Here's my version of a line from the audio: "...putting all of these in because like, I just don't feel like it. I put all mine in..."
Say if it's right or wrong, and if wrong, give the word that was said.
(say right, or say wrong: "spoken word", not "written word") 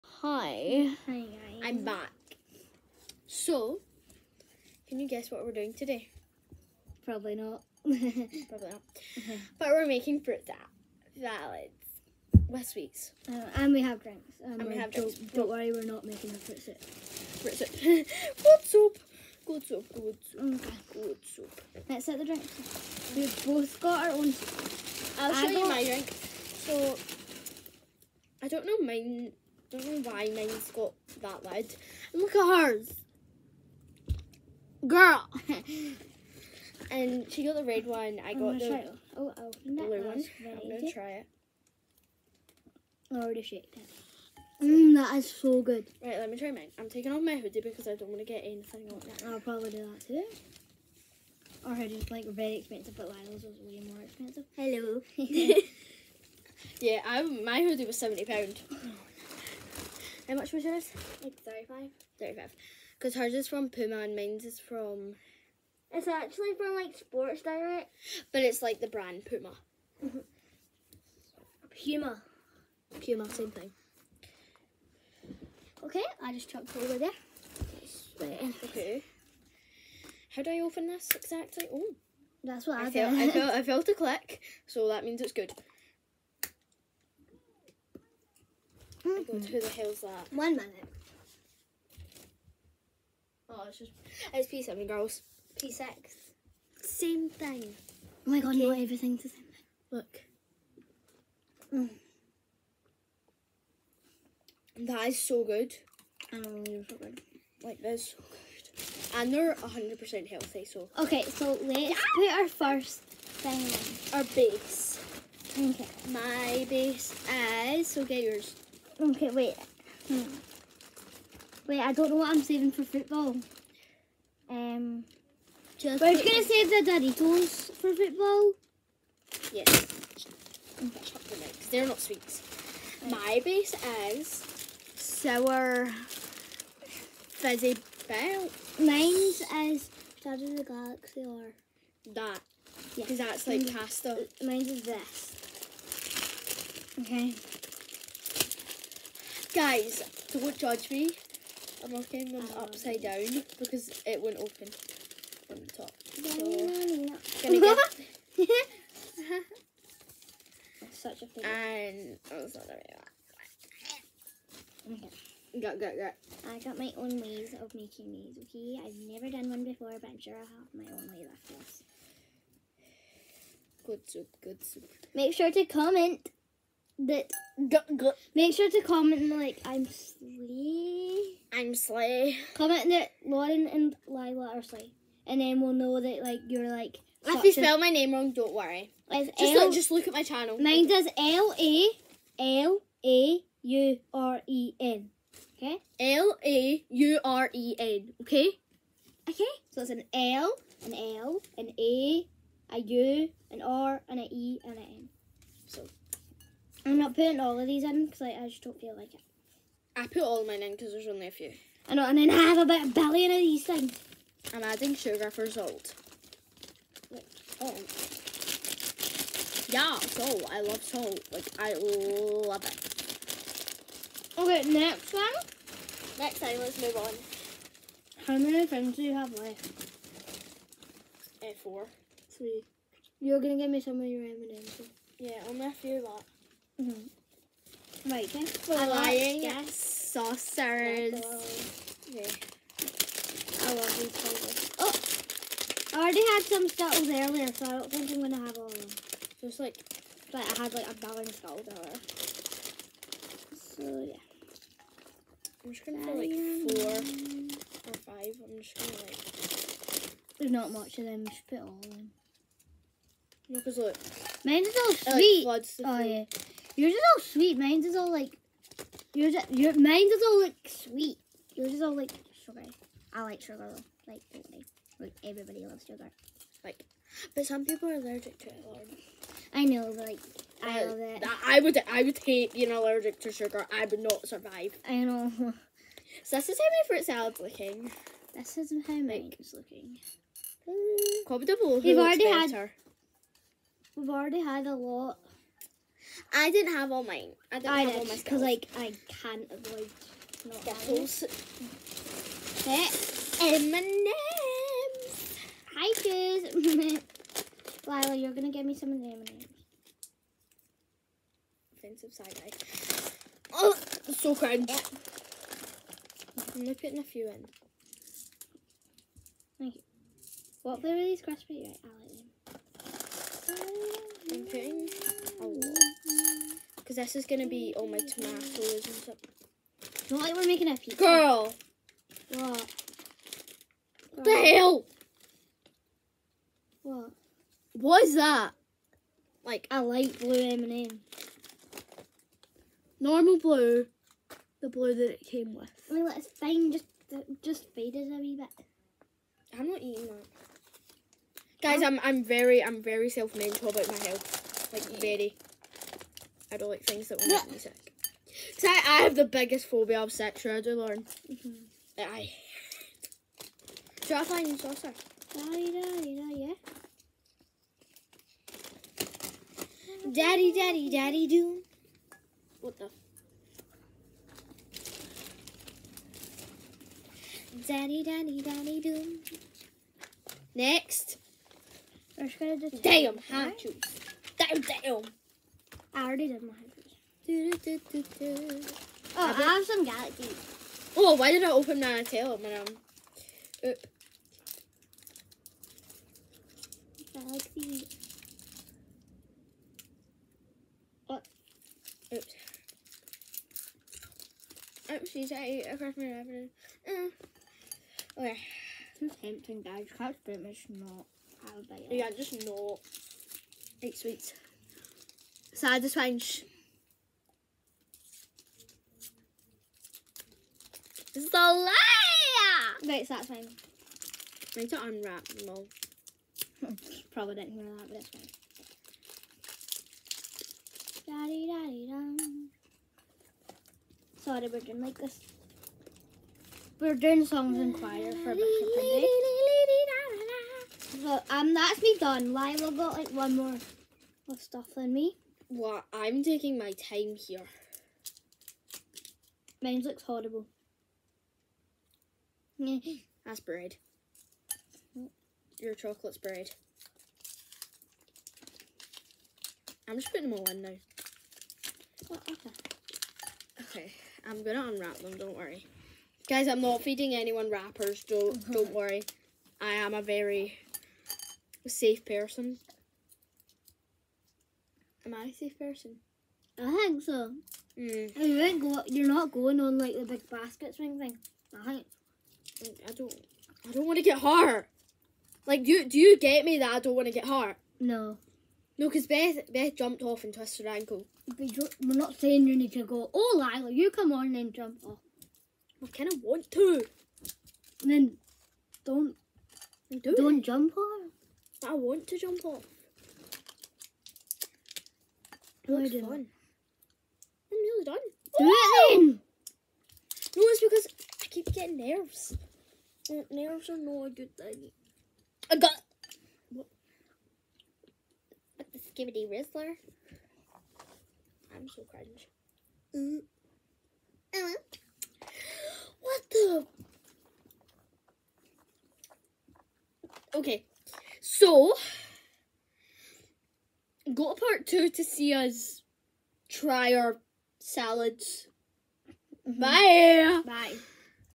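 right.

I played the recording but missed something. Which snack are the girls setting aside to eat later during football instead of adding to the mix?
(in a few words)
Doritos.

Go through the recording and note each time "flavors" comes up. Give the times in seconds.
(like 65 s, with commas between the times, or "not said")
244 s, 320 s.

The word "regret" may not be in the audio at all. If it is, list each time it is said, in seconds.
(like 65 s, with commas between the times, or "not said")
not said.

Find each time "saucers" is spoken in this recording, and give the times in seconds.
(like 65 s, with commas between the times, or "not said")
239 s, 364 s.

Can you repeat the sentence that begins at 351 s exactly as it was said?
Guys, I'm I'm very I'm very self-mindful about my health.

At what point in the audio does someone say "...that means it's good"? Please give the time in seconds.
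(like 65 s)
84 s.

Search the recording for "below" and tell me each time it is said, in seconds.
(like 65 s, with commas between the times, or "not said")
291 s.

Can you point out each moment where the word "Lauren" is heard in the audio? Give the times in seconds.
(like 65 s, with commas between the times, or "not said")
183 s, 360 s.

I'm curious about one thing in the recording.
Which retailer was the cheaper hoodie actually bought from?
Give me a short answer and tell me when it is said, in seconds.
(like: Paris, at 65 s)
Sports Direct, at 66 s.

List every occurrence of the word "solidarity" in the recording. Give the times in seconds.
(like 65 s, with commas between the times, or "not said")
not said.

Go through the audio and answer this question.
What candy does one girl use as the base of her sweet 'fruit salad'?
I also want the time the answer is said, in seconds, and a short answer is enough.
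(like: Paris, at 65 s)
sour fizzy bell, at 134 s.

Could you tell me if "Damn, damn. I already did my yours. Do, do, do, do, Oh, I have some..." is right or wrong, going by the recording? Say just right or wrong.
wrong.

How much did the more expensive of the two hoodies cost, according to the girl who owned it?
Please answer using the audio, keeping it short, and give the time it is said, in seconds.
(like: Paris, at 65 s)
£70, at 57 s.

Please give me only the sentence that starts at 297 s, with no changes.
I didn't I have did, all my because like I can't avoid not Skittles.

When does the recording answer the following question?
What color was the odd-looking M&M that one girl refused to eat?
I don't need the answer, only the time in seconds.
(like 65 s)
339 s.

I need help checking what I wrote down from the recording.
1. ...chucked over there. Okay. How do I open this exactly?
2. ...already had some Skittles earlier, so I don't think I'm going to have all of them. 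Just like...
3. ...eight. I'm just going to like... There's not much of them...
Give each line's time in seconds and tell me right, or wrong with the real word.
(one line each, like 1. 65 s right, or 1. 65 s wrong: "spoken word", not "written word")
1. 76 s right
2. 246 s right
3. 257 s wrong: "five", not "eight".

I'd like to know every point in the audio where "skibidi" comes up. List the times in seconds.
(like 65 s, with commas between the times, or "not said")
518 s.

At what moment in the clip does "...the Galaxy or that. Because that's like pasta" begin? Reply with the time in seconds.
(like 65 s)
140 s.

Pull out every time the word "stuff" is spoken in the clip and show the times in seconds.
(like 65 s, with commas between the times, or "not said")
328 s, 444 s.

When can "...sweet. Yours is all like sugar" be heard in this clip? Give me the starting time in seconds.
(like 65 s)
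270 s.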